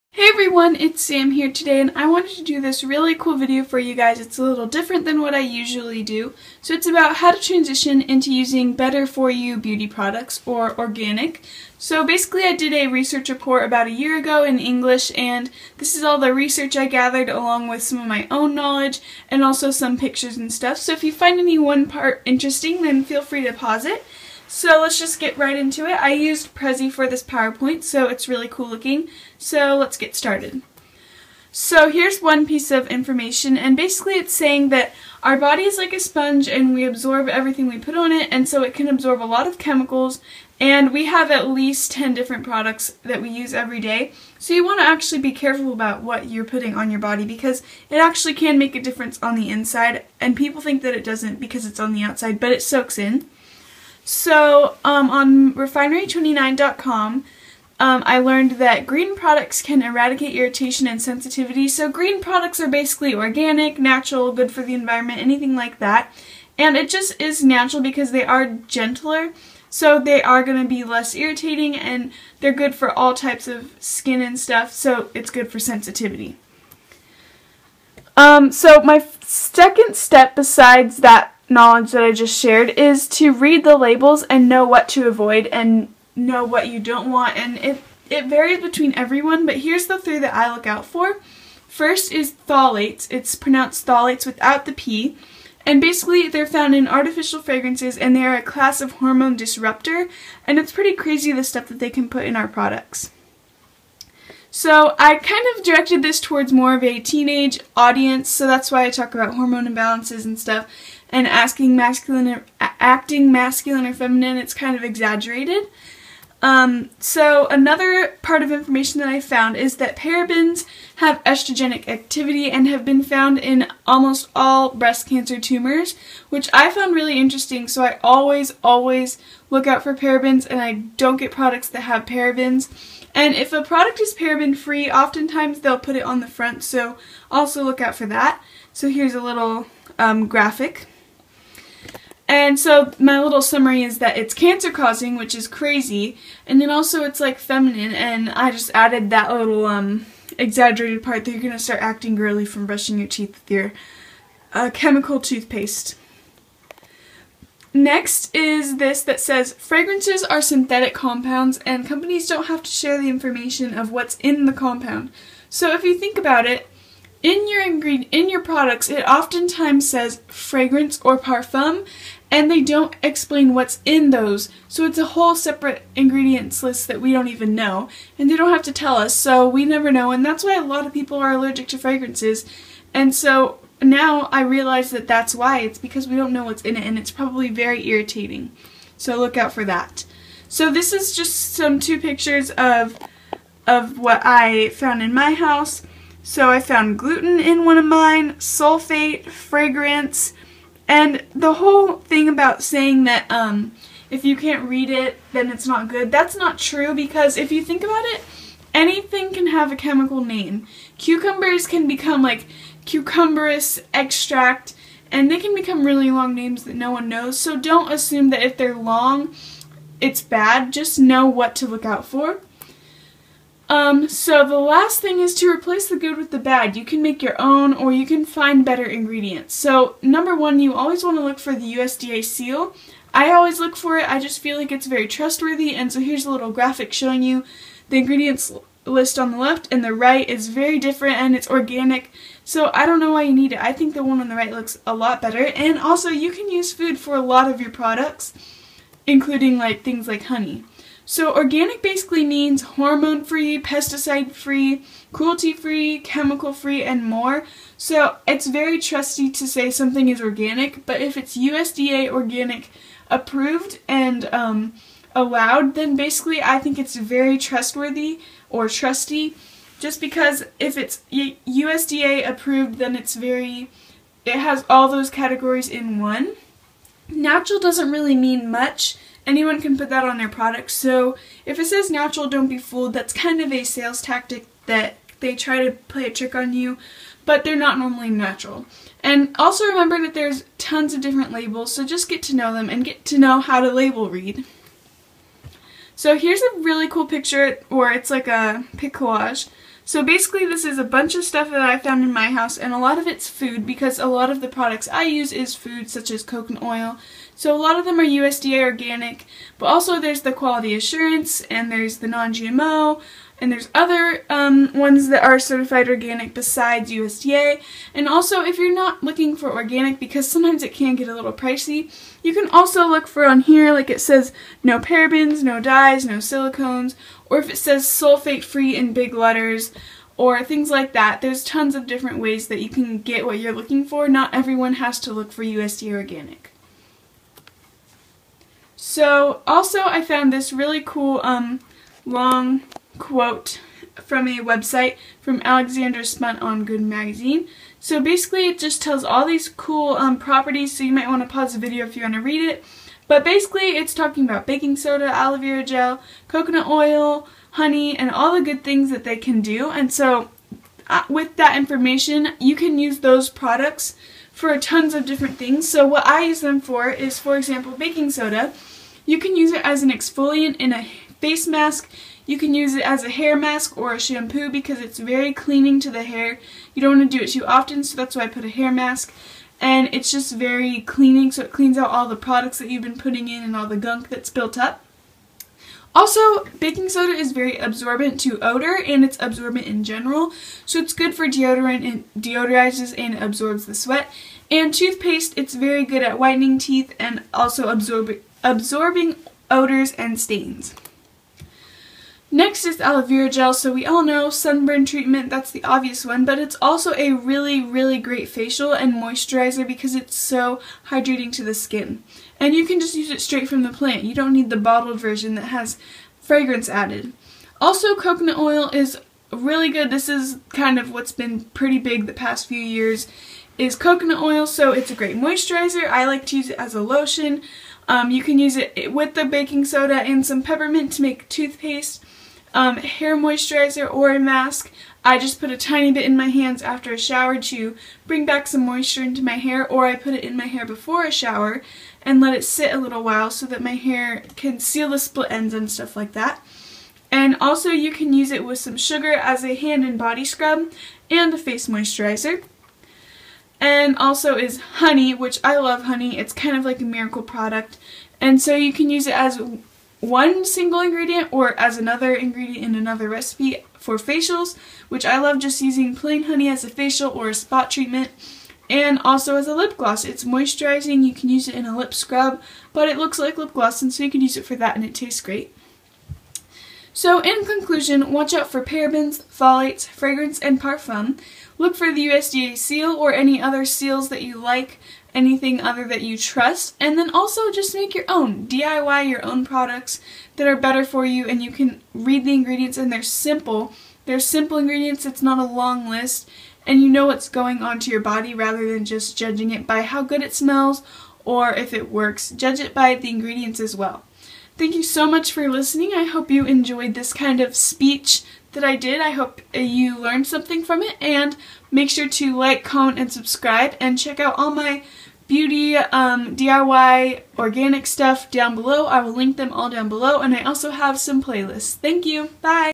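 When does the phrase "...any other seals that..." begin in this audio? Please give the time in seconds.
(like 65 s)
483 s.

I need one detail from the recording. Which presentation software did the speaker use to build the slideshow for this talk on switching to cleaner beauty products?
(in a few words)
Prezi.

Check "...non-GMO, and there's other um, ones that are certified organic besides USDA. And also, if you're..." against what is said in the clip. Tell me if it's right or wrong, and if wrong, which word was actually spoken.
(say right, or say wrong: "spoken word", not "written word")
right.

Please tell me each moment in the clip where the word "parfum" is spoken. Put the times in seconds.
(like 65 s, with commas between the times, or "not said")
171 s, 480 s.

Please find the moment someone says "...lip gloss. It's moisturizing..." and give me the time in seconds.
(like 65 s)
469 s.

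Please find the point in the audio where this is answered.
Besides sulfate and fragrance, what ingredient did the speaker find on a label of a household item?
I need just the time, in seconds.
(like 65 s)
196 s.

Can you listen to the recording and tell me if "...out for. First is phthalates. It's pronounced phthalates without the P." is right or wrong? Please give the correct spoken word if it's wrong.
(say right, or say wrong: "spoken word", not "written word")
right.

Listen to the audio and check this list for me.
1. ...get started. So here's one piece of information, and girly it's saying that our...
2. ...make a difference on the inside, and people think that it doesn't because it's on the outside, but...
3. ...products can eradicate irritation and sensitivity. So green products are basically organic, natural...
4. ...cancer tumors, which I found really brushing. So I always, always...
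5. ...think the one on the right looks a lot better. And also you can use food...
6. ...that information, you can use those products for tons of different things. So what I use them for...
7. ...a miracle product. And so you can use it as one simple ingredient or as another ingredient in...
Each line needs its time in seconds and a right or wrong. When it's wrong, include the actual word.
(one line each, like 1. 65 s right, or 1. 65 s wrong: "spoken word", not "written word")
1. 29 s wrong: "basically", not "girly"
2. 48 s right
3. 59 s right
4. 125 s wrong: "interesting", not "brushing"
5. 243 s right
6. 361 s right
7. 456 s wrong: "single", not "simple".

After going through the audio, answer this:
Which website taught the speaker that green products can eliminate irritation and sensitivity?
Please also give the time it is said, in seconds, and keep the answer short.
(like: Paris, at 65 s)
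refinery29.com, at 55 s.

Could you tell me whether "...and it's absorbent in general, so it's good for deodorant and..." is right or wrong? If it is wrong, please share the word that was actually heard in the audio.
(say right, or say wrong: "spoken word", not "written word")
right.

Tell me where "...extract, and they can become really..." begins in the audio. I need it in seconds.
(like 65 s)
213 s.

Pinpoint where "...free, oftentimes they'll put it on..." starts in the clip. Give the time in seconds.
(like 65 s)
134 s.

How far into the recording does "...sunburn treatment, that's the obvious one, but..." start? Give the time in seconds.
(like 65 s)
404 s.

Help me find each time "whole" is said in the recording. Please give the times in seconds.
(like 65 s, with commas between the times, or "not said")
175 s, 201 s.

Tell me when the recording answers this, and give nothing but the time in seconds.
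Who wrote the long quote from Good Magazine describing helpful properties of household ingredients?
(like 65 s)
345 s.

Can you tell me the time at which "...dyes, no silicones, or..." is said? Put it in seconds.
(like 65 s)
325 s.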